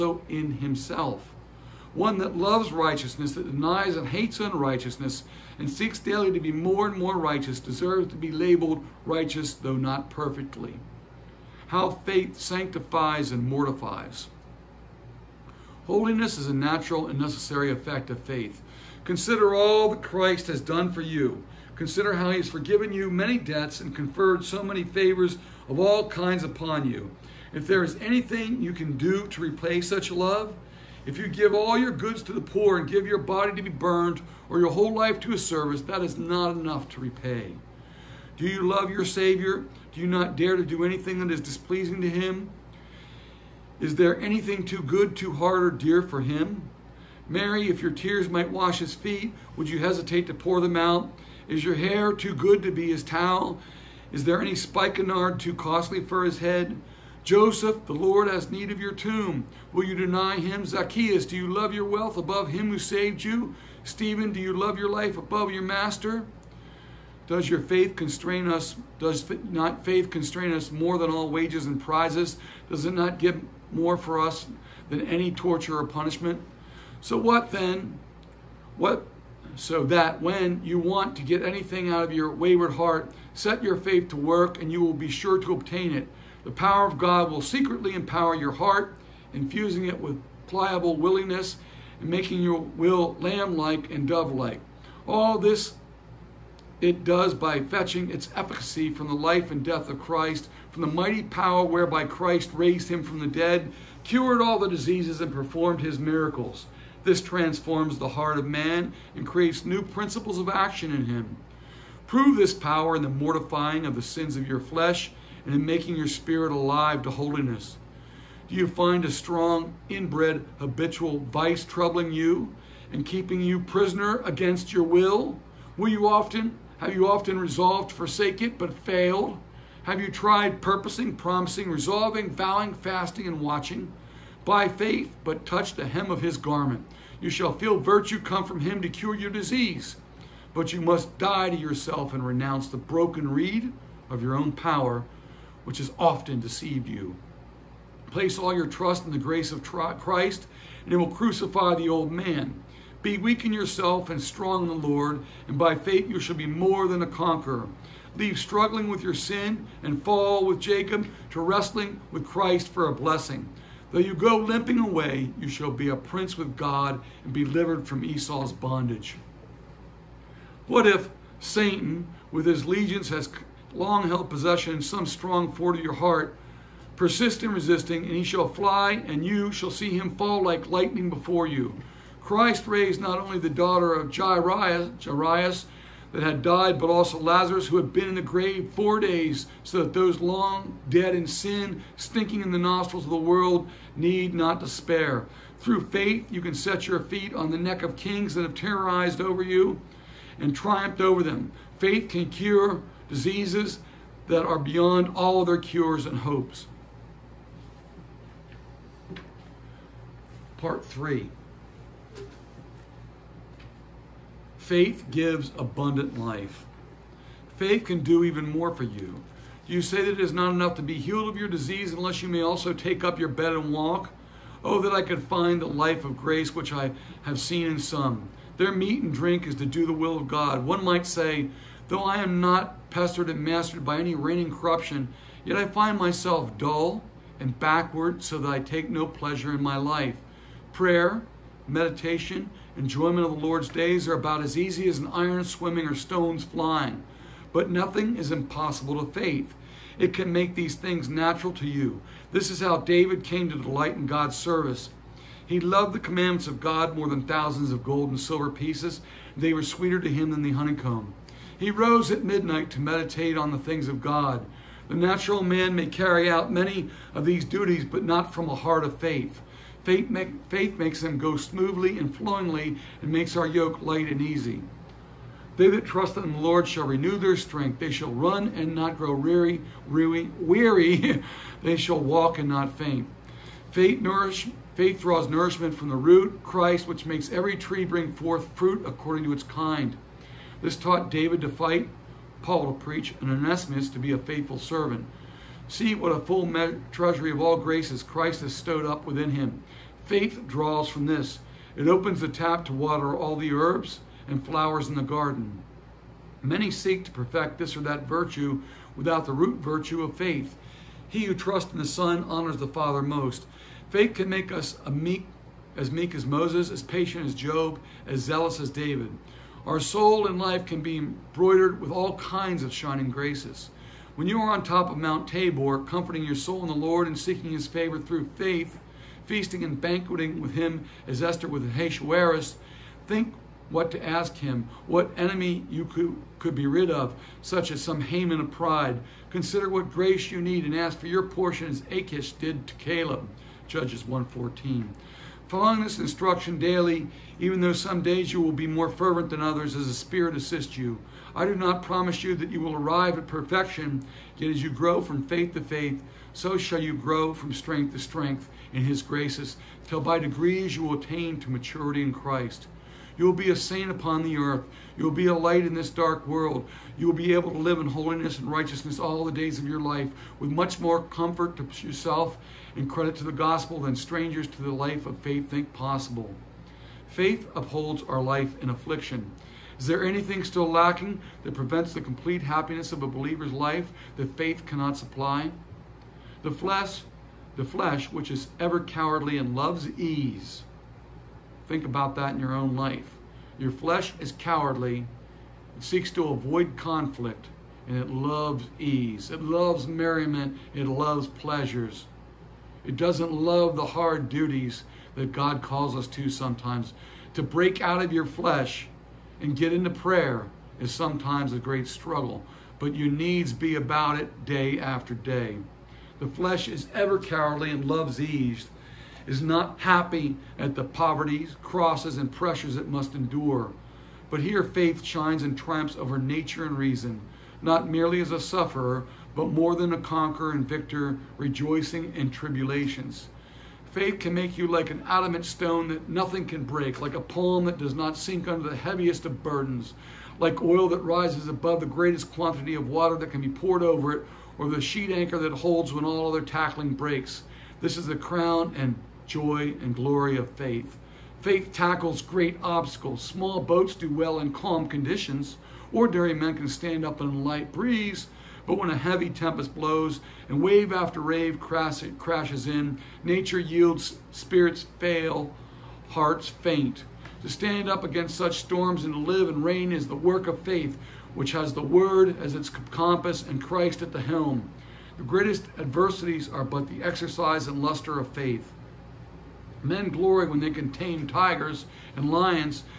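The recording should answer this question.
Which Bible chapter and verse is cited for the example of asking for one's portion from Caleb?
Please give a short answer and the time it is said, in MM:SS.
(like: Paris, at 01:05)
Judges 1:14, at 05:43.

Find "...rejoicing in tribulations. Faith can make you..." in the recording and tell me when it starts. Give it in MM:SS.
07:11.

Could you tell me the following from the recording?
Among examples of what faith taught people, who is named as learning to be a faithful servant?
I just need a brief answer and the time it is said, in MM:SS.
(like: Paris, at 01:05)
Onesimus, at 04:53.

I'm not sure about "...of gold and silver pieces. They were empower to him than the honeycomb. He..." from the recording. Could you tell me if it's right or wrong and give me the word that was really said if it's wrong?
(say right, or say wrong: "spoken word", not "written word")
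wrong: "sweeter", not "empower".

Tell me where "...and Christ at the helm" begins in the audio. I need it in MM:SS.
07:53.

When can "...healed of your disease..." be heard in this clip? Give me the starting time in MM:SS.
03:40.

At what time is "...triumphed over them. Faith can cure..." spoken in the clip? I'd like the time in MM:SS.
03:20.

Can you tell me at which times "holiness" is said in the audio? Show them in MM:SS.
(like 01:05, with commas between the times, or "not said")
00:15, 01:57, 06:07.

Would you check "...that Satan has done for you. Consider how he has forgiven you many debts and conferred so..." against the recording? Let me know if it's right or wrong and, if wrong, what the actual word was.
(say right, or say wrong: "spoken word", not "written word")
wrong: "Christ", not "Satan".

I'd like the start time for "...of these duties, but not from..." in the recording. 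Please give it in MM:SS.
04:27.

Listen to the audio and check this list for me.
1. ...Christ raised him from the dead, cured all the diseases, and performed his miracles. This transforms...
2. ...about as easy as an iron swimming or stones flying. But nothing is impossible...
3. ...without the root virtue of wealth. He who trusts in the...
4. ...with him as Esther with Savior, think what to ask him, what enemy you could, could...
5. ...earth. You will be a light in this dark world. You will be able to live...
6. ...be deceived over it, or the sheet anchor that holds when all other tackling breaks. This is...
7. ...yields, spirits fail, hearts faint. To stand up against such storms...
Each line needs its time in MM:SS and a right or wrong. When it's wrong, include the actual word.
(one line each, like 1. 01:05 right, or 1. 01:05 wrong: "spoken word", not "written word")
1. 01:42 right
2. 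04:04 right
3. 05:08 wrong: "faith", not "wealth"
4. 05:30 wrong: "Ahasuerus", not "Savior"
5. 06:04 right
6. 07:23 wrong: "poured", not "deceived"
7. 07:43 right.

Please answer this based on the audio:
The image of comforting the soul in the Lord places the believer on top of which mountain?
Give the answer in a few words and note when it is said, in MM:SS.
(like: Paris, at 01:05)
Mount Tabor, at 05:24.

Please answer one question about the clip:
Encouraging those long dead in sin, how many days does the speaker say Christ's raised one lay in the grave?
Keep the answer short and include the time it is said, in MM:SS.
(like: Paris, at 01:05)
4, at 03:08.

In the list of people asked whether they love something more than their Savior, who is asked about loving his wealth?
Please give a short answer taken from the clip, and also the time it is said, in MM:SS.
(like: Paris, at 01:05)
Zacchaeus, at 01:00.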